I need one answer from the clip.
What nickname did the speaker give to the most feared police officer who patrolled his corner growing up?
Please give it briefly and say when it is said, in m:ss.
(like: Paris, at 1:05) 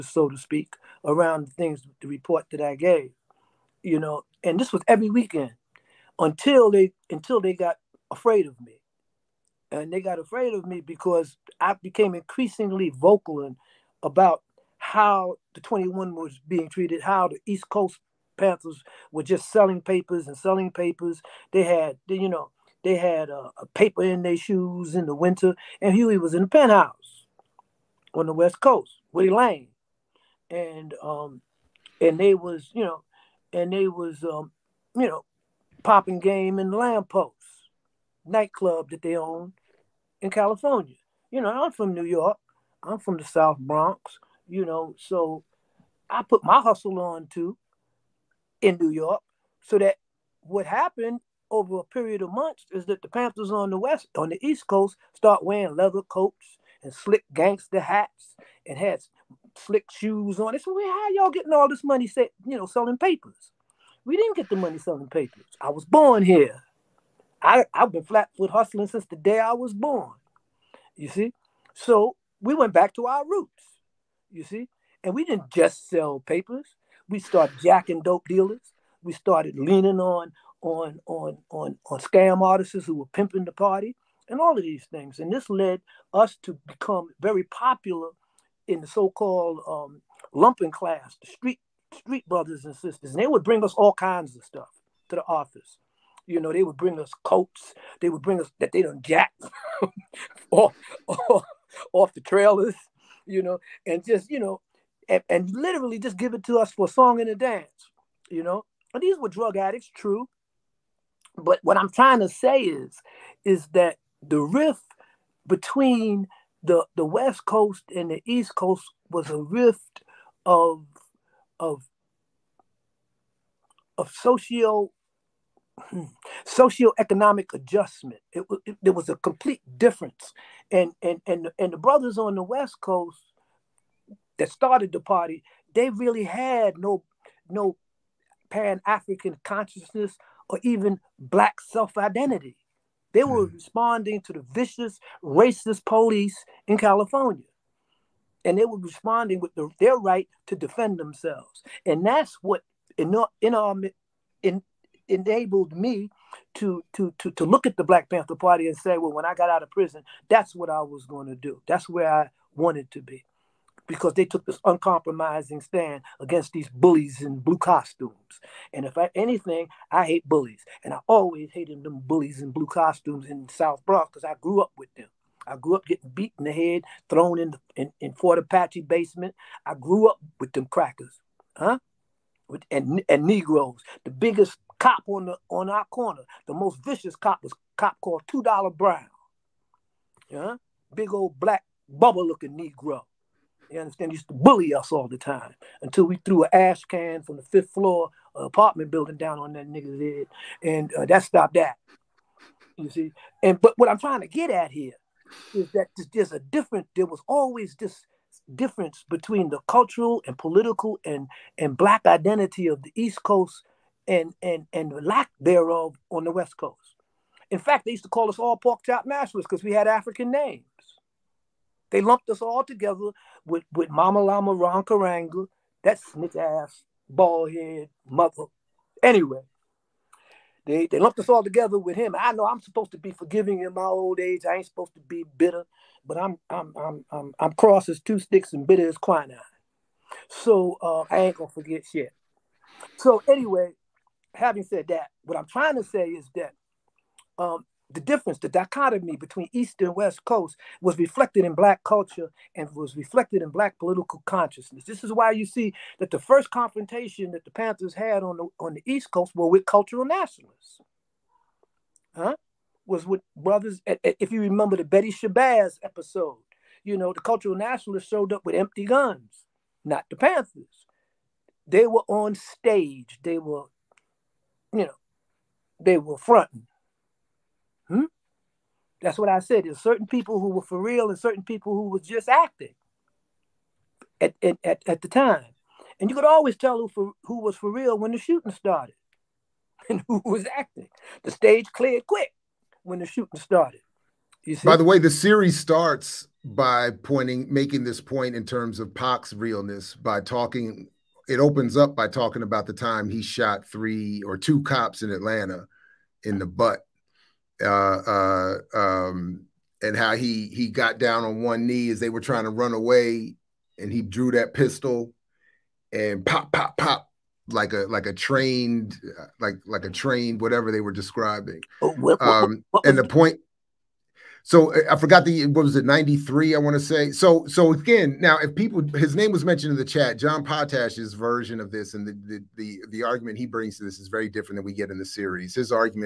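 Two Dollar Brown, at 3:08.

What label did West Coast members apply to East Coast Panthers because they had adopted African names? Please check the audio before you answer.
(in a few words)
pork chop nationalists.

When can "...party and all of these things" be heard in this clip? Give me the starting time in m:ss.
1:23.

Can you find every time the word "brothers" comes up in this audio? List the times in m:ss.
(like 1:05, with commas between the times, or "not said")
1:32, 2:11, 4:23.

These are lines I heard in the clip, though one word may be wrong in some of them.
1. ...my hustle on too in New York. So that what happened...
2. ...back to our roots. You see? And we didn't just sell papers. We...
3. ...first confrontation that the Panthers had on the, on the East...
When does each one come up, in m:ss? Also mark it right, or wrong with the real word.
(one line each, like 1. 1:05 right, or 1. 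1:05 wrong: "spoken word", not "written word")
1. 0:46 right
2. 1:12 right
3. 4:16 right.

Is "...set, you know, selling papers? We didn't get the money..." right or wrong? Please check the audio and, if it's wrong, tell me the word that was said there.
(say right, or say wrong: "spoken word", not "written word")
right.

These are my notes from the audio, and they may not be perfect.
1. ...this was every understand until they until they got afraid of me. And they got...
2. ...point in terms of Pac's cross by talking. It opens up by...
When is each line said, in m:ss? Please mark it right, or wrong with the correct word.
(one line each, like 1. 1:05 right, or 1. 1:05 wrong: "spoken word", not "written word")
1. 0:04 wrong: "weekend", not "understand"
2. 4:58 wrong: "realness", not "cross".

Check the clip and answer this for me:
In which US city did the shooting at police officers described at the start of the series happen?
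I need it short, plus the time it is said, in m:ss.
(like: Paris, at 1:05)
Atlanta, at 5:05.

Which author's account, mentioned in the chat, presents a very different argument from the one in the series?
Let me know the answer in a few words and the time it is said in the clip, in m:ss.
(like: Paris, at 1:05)
John Potash, at 5:30.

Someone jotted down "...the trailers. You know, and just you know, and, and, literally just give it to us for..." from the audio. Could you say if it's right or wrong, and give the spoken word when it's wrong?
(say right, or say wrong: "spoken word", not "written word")
right.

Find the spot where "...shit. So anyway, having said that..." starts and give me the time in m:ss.
4:01.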